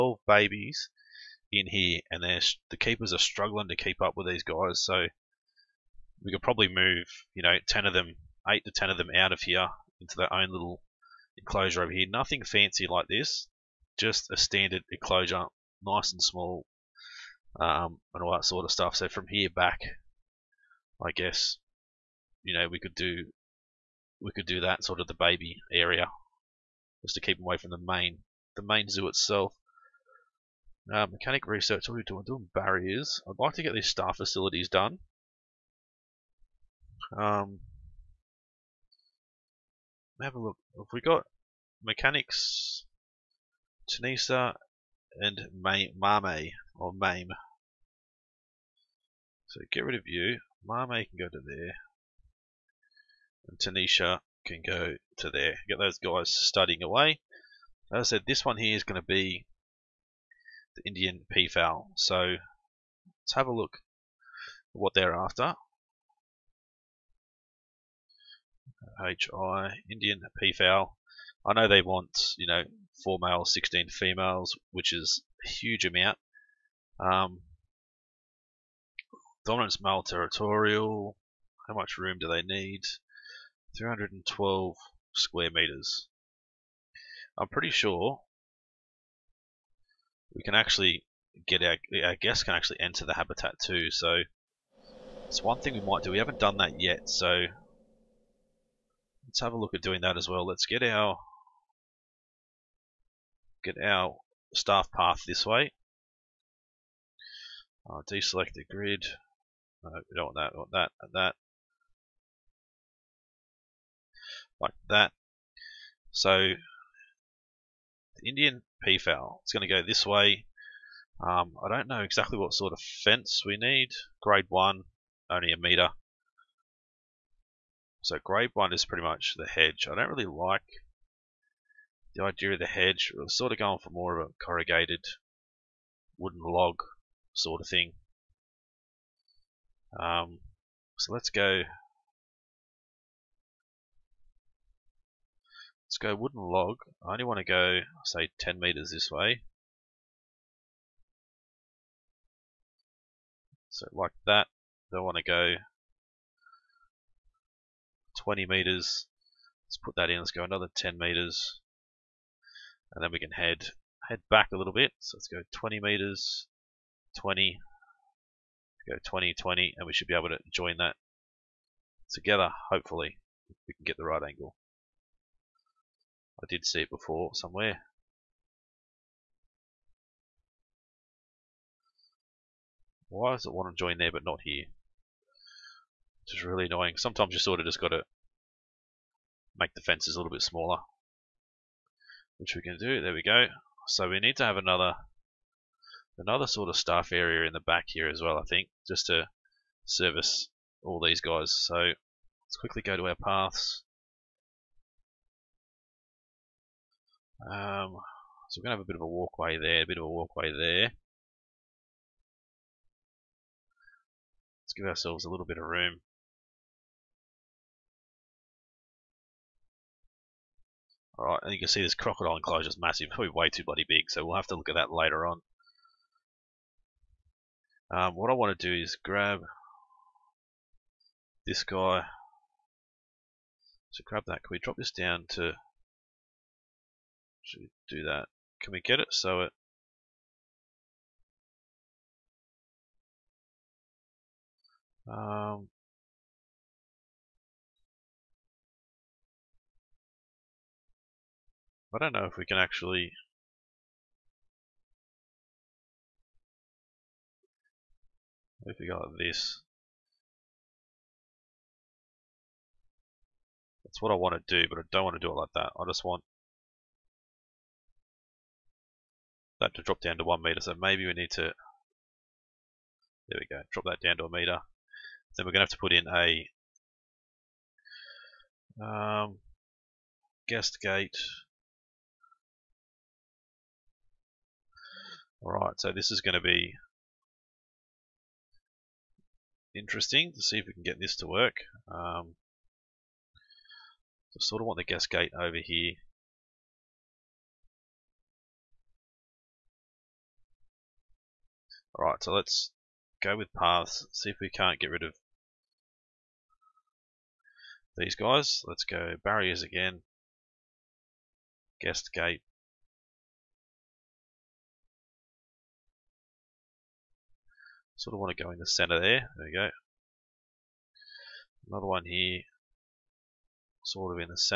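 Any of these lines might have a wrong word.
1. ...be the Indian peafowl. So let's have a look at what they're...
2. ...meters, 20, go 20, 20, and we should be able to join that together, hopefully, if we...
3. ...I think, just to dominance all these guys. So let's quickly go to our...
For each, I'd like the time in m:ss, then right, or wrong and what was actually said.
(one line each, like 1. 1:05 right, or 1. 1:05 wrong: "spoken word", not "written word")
1. 0:59 right
2. 2:45 right
3. 3:18 wrong: "service", not "dominance".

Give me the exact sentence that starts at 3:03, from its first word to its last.
Why does it want to join there but not here?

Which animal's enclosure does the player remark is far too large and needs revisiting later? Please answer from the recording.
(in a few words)
Crocodile.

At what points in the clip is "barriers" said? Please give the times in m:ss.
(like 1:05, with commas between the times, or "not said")
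0:32, 5:09.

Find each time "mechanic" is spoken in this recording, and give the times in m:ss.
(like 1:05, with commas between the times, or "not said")
0:31, 0:41.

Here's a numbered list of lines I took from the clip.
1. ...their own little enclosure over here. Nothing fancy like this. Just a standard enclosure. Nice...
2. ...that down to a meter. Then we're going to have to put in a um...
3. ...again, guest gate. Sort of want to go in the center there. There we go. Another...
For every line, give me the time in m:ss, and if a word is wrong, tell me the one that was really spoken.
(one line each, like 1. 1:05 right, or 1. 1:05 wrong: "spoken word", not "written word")
1. 0:10 right
2. 4:33 right
3. 5:09 right.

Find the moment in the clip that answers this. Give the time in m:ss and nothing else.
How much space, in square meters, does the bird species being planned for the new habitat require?
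1:23.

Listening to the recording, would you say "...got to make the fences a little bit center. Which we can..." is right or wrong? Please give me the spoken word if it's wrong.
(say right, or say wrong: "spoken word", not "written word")
wrong: "smaller", not "center".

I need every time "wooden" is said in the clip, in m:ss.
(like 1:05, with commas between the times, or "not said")
2:16, 2:26.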